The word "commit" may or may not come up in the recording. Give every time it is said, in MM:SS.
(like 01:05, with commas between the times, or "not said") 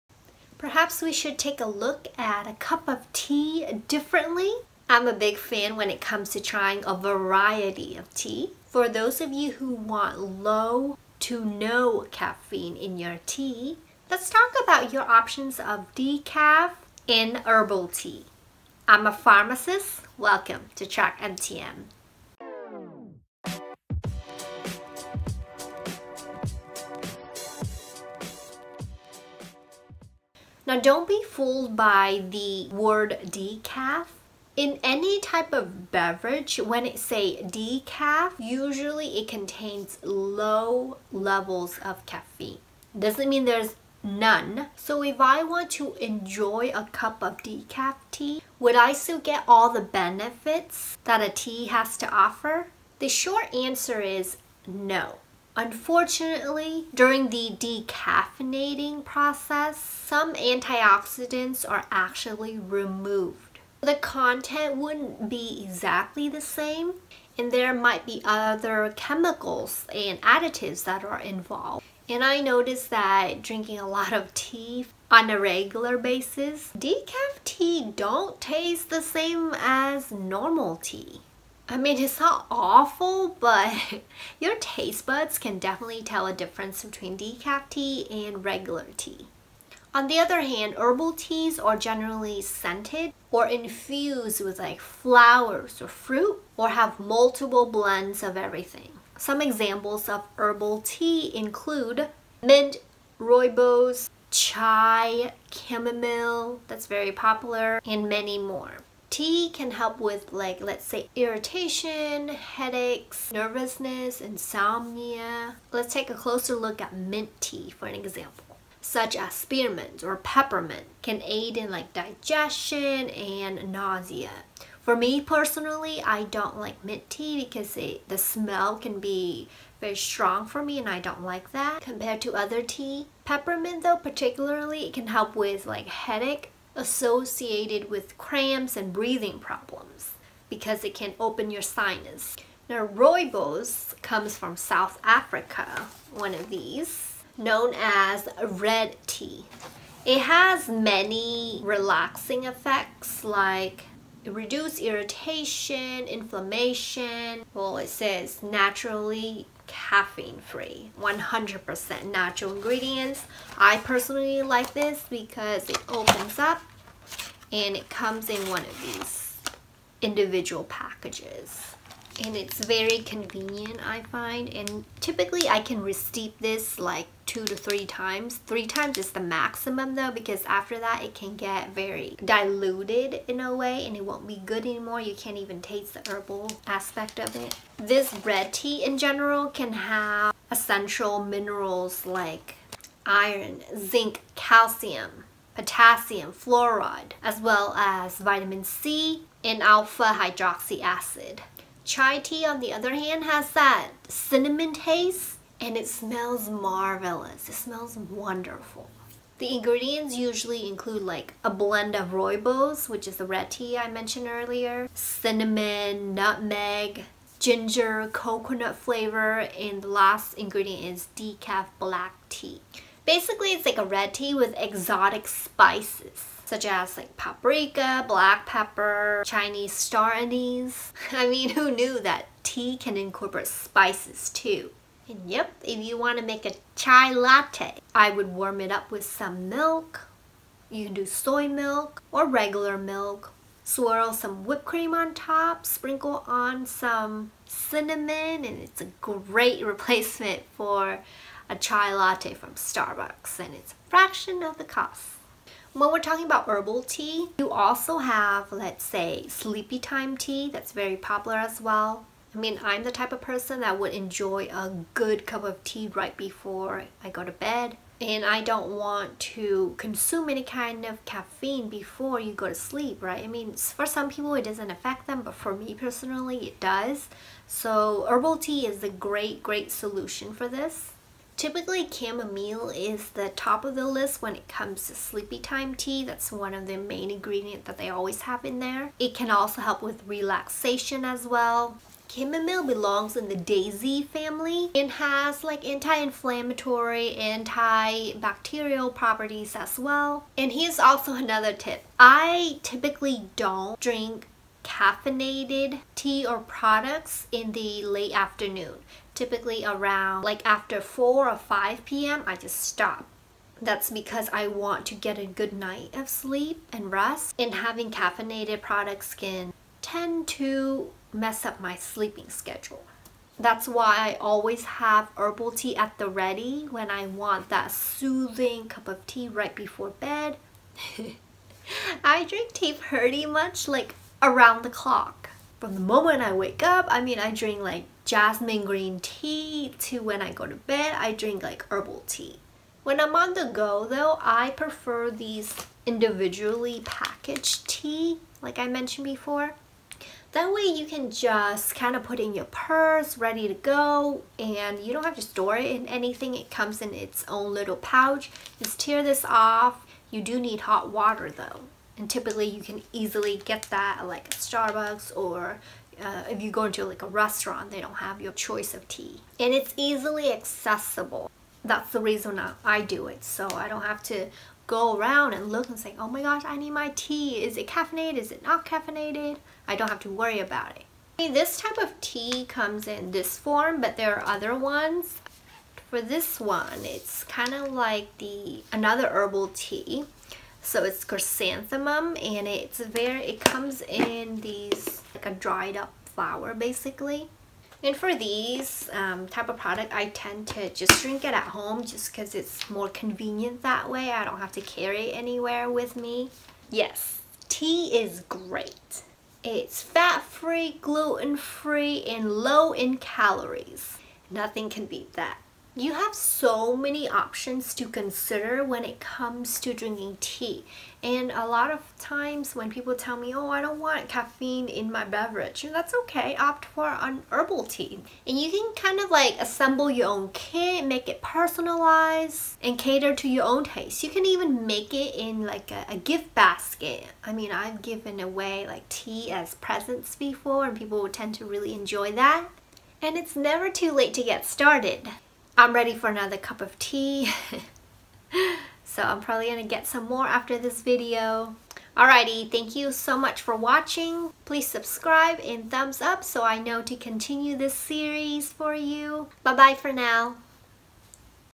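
not said.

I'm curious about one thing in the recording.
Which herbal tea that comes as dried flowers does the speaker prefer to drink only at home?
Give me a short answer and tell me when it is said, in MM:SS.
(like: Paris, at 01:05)
Chrysanthemum, at 06:31.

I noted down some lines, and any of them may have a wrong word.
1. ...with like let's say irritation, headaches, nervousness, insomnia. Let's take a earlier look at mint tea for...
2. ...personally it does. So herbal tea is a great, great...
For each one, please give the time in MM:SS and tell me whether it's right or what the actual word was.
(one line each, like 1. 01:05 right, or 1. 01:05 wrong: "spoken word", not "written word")
1. 01:49 wrong: "closer", not "earlier"
2. 04:35 right.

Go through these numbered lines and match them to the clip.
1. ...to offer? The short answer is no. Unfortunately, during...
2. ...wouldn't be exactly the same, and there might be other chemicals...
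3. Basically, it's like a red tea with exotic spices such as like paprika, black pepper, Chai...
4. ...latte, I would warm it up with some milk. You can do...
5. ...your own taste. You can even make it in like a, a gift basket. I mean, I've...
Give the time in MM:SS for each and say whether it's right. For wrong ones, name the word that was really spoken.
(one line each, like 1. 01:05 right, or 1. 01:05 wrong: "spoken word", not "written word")
1. 00:51 right
2. 01:04 right
3. 03:43 wrong: "Chinese", not "Chai"
4. 03:57 right
5. 07:13 right.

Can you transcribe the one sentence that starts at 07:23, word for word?
And it's never too late to get started.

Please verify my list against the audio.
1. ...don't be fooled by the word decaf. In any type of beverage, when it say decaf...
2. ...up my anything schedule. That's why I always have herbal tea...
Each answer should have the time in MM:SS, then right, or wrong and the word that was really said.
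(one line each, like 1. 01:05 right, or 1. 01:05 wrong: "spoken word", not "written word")
1. 00:30 right
2. 05:21 wrong: "sleeping", not "anything".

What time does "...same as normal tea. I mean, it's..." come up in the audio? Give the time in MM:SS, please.
01:19.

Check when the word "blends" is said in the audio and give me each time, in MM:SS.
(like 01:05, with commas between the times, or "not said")
01:37, 03:31.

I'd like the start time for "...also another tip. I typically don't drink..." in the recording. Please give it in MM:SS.
05:00.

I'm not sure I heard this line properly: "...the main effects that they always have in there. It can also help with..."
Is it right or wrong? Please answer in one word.
wrong.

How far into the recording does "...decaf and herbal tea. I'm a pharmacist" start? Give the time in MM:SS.
00:15.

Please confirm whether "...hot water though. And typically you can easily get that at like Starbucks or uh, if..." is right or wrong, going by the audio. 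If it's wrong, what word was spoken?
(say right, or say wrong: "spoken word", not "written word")
right.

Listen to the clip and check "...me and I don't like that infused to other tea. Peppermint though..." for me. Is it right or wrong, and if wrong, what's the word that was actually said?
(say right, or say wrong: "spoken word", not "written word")
wrong: "compared", not "infused".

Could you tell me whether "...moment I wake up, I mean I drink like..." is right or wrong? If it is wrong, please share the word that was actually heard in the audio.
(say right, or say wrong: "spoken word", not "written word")
right.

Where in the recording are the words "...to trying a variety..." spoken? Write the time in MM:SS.
00:06.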